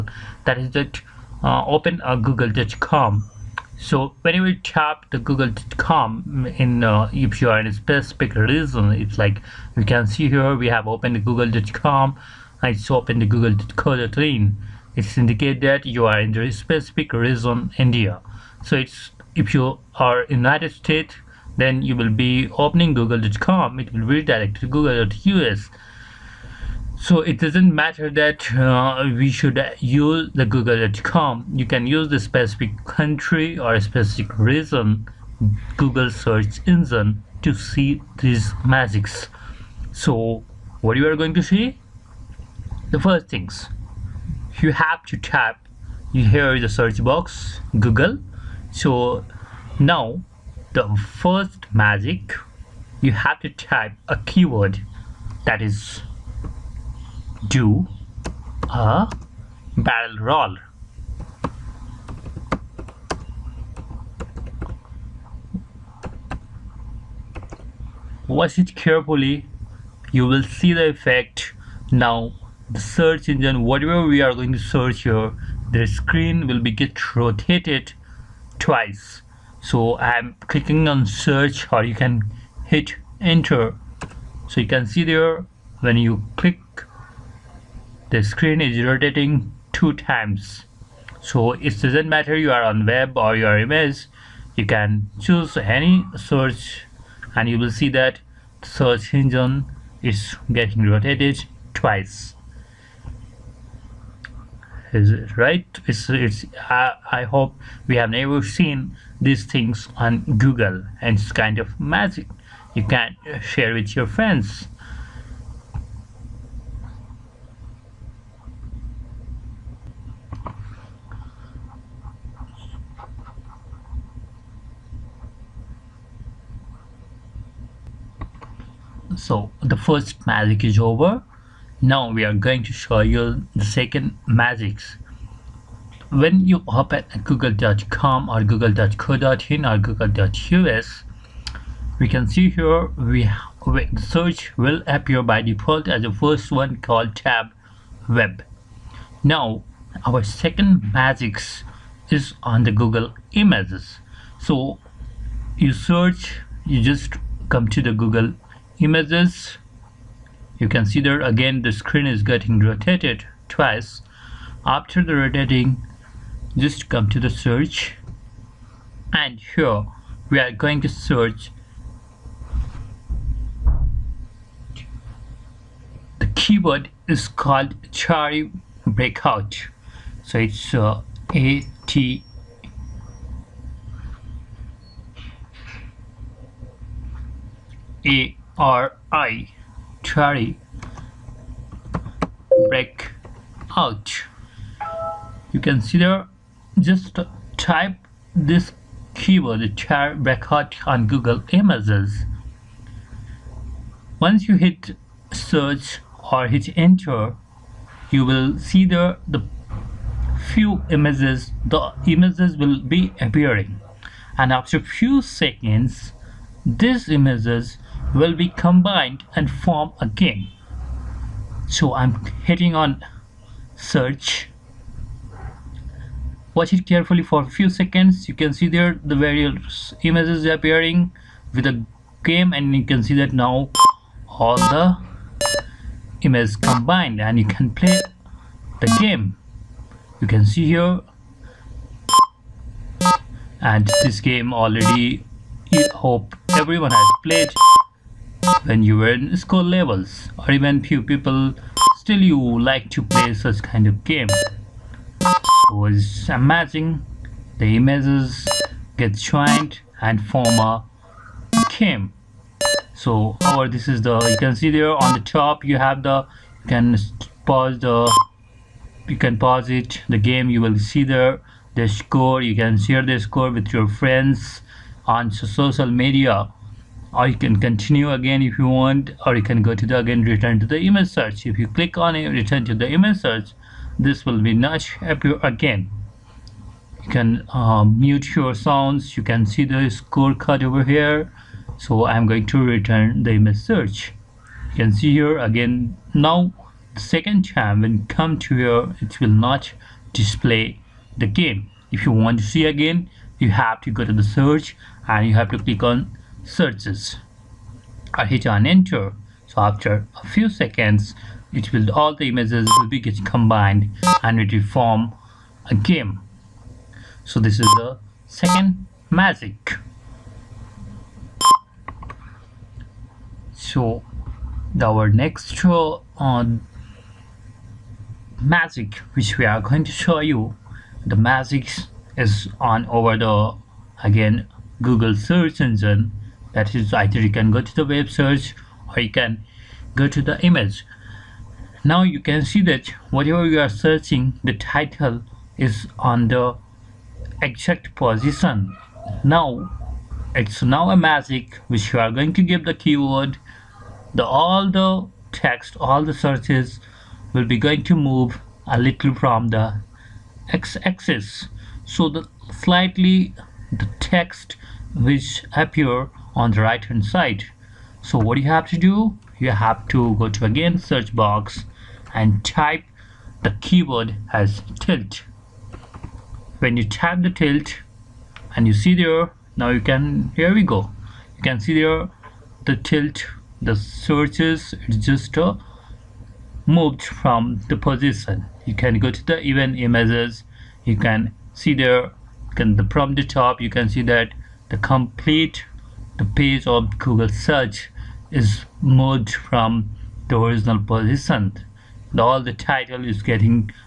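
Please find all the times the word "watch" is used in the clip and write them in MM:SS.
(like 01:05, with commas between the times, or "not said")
01:08, 03:46.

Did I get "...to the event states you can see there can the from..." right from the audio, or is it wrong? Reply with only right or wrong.
wrong.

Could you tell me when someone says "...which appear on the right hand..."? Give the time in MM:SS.
06:04.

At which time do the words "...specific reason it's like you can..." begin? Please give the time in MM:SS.
00:07.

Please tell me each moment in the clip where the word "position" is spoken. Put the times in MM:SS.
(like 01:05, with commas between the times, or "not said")
05:47, 06:27, 06:40.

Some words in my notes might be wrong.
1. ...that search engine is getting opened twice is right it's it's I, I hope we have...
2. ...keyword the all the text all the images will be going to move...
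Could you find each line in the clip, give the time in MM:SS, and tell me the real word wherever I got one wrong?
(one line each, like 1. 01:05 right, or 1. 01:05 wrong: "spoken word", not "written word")
1. 01:37 wrong: "rotated", not "opened"
2. 05:52 wrong: "searches", not "images".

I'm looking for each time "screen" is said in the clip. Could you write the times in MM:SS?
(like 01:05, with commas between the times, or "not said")
01:16, 01:28, 02:41.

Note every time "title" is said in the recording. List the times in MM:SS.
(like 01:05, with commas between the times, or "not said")
05:44, 06:42.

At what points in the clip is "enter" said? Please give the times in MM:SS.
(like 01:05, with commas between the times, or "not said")
01:23, 03:26, 05:08.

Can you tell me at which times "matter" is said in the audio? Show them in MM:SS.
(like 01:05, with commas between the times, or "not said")
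00:27, 01:32.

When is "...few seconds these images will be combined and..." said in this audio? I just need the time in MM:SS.
03:34.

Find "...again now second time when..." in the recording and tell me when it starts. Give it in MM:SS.
04:55.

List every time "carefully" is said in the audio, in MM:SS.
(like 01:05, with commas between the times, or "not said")
01:08, 03:46.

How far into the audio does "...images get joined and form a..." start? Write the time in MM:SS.
04:17.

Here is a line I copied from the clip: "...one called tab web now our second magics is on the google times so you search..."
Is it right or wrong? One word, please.
wrong.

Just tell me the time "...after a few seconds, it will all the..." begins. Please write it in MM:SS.
05:09.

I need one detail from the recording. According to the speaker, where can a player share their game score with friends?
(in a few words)
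social media.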